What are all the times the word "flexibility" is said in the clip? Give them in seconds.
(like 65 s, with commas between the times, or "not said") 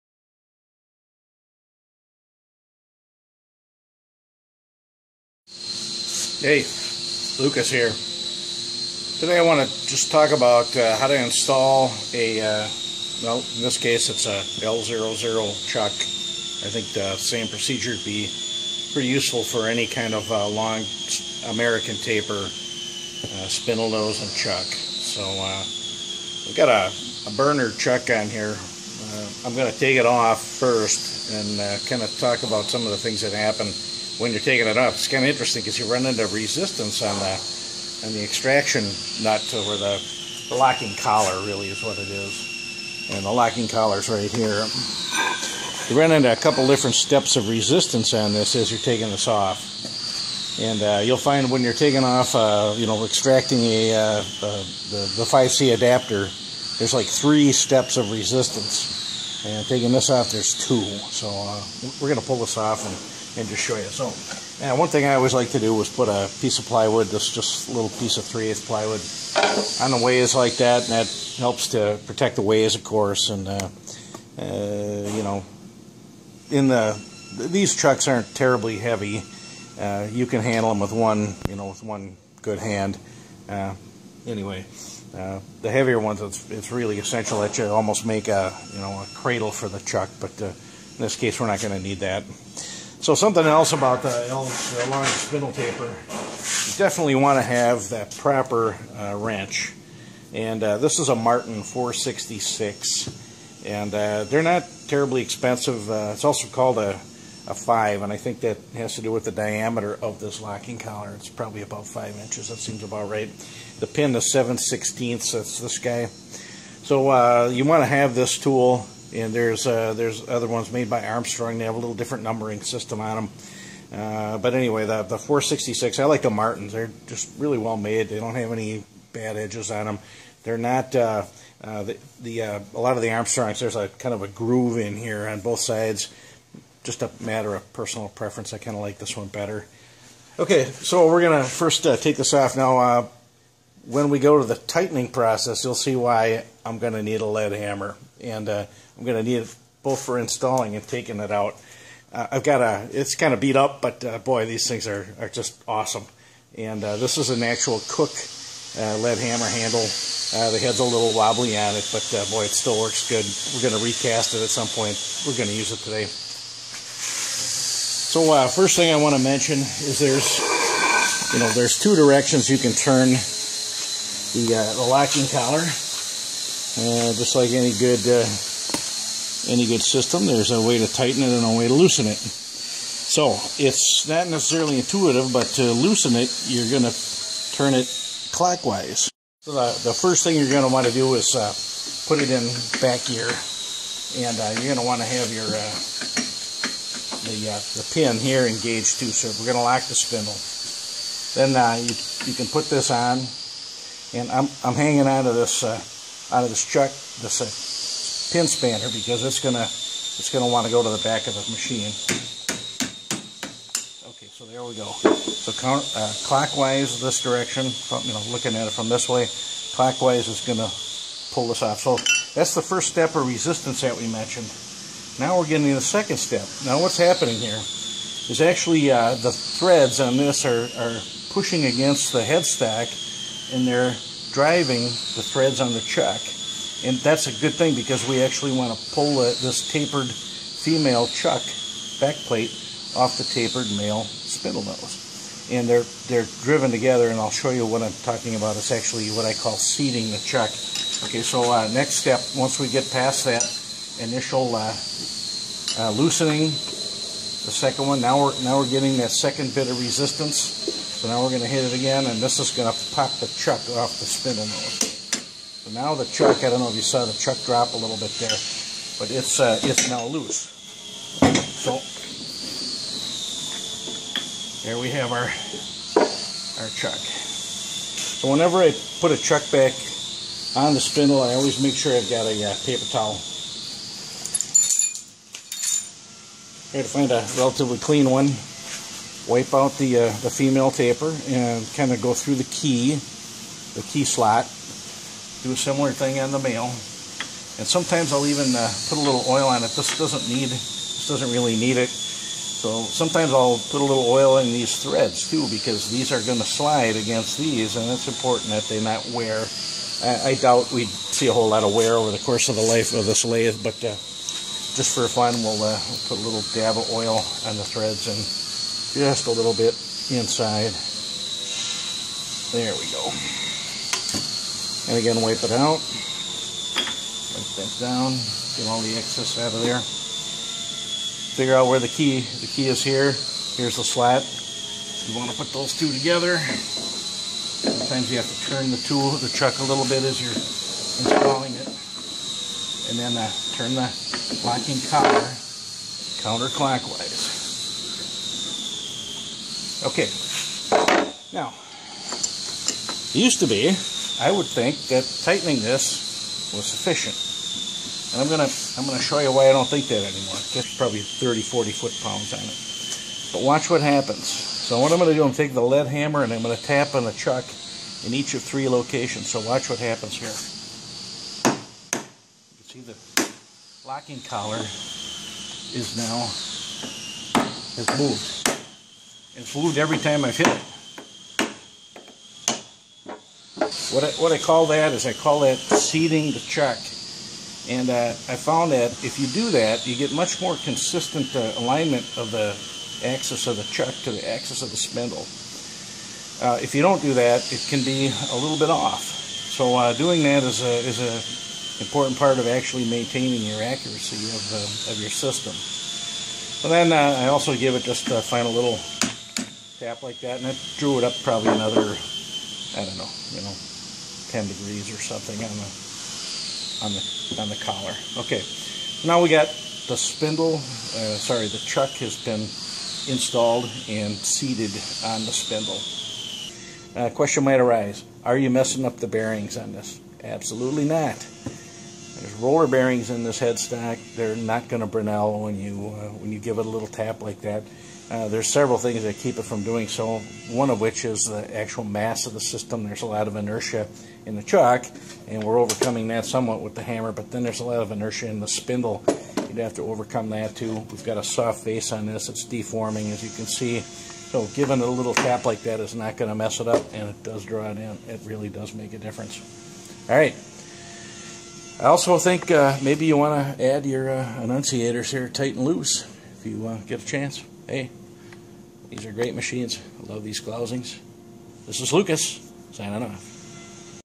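not said.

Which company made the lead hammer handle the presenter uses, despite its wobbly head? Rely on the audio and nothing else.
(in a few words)
Cook.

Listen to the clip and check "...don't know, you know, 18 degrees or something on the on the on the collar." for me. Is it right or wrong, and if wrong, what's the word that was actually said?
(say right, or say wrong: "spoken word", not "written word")
wrong: "10", not "18".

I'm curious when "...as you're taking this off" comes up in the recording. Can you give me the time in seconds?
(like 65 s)
48 s.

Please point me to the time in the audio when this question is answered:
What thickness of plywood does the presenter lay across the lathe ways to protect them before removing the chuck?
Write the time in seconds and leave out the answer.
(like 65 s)
68 s.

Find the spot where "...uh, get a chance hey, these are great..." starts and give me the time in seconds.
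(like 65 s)
466 s.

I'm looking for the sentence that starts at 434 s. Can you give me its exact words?
They're not going to Brinell when you uh, when you give it a little tap like that.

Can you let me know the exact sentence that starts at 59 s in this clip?
And taking this off, there's two.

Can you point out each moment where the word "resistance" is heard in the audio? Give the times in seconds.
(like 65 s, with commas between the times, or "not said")
36 s, 47 s, 58 s, 223 s, 259 s.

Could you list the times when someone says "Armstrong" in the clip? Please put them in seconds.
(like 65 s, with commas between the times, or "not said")
121 s, 133 s.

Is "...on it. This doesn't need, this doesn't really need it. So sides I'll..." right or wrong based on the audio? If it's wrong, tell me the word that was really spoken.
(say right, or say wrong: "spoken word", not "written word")
wrong: "sometimes", not "sides".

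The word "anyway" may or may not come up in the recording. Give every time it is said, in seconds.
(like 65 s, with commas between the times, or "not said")
84 s, 124 s.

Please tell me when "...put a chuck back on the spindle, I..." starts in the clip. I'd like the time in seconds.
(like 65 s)
279 s.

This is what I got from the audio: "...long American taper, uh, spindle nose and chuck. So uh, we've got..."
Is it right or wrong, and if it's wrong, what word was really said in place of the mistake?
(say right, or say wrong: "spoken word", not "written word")
right.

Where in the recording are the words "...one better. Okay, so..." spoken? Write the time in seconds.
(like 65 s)
139 s.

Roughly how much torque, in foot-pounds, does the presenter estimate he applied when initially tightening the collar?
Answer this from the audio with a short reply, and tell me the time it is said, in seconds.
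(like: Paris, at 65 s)
30 to 40 foot-pounds, at 360 s.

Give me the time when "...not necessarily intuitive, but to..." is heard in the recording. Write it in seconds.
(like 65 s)
184 s.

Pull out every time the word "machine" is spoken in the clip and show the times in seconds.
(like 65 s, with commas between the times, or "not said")
211 s, 469 s.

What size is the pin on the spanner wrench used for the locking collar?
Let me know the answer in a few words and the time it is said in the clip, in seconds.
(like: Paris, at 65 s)
7/16, at 114 s.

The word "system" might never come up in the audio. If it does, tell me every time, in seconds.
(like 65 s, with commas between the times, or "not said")
122 s, 179 s, 405 s, 442 s.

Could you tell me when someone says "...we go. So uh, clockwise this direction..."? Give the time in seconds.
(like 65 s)
214 s.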